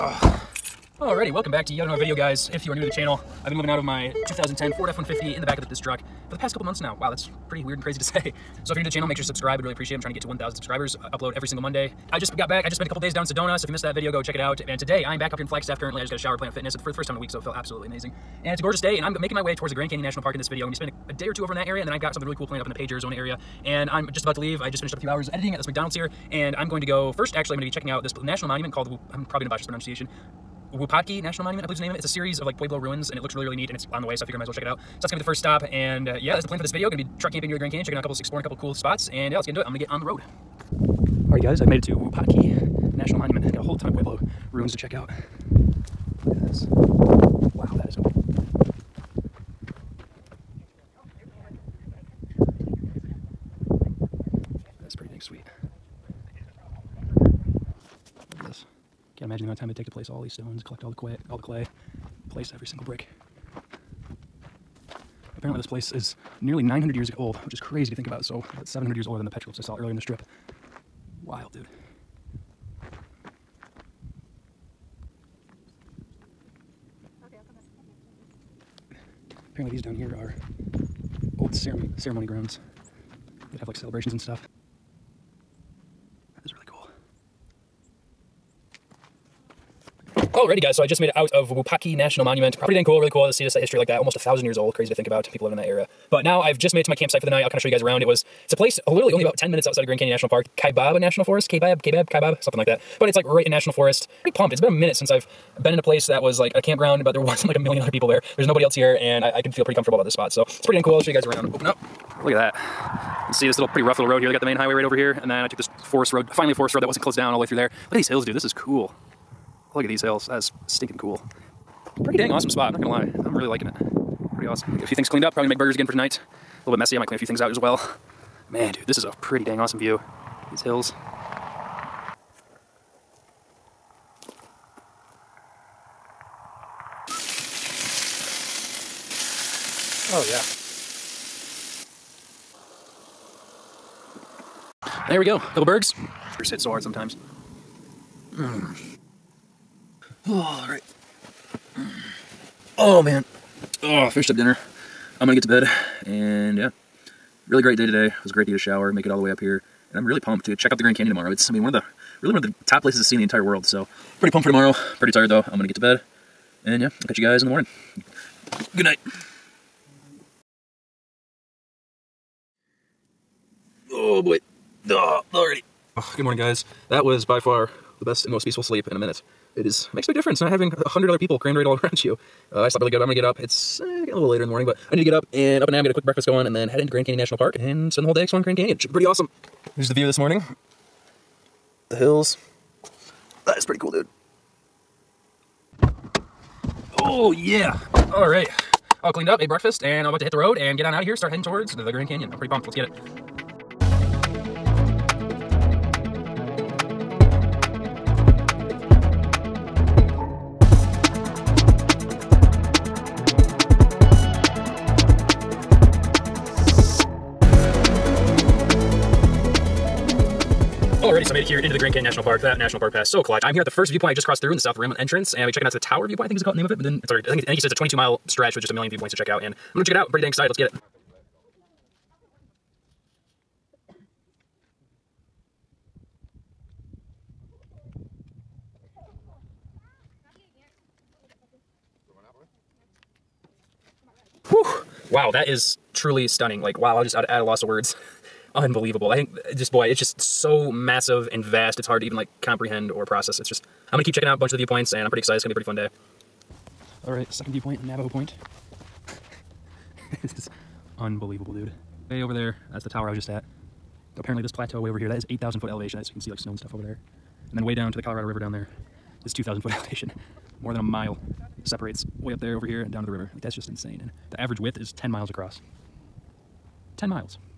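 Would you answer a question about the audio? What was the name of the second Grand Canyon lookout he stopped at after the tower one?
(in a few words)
Navajo Point.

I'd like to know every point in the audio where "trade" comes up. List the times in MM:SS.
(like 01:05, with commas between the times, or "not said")
not said.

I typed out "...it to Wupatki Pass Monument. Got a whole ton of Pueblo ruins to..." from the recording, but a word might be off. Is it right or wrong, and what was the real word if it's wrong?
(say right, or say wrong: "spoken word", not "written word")
wrong: "National", not "Pass".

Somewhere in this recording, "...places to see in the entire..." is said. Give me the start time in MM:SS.
02:42.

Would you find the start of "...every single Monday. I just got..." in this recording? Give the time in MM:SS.
00:11.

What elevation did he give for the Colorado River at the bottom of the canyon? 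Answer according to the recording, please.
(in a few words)
2,000 feet.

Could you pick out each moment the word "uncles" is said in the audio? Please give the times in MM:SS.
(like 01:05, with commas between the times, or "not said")
not said.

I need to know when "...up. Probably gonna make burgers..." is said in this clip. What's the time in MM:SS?
02:05.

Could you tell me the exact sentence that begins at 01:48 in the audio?
There's nobody else here, and I, I can feel pretty comfortable about this spot.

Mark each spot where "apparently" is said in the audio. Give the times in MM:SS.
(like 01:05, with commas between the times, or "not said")
01:05, 01:19, 04:24.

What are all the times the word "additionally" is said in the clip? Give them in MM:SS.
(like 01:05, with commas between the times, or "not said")
not said.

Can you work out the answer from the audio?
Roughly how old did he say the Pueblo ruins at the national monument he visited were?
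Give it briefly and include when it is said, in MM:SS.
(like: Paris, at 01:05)
900 years, at 01:06.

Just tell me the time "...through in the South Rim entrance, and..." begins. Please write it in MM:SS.
03:44.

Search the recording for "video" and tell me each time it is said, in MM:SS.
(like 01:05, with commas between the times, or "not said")
00:01, 00:13, 00:20, 00:36.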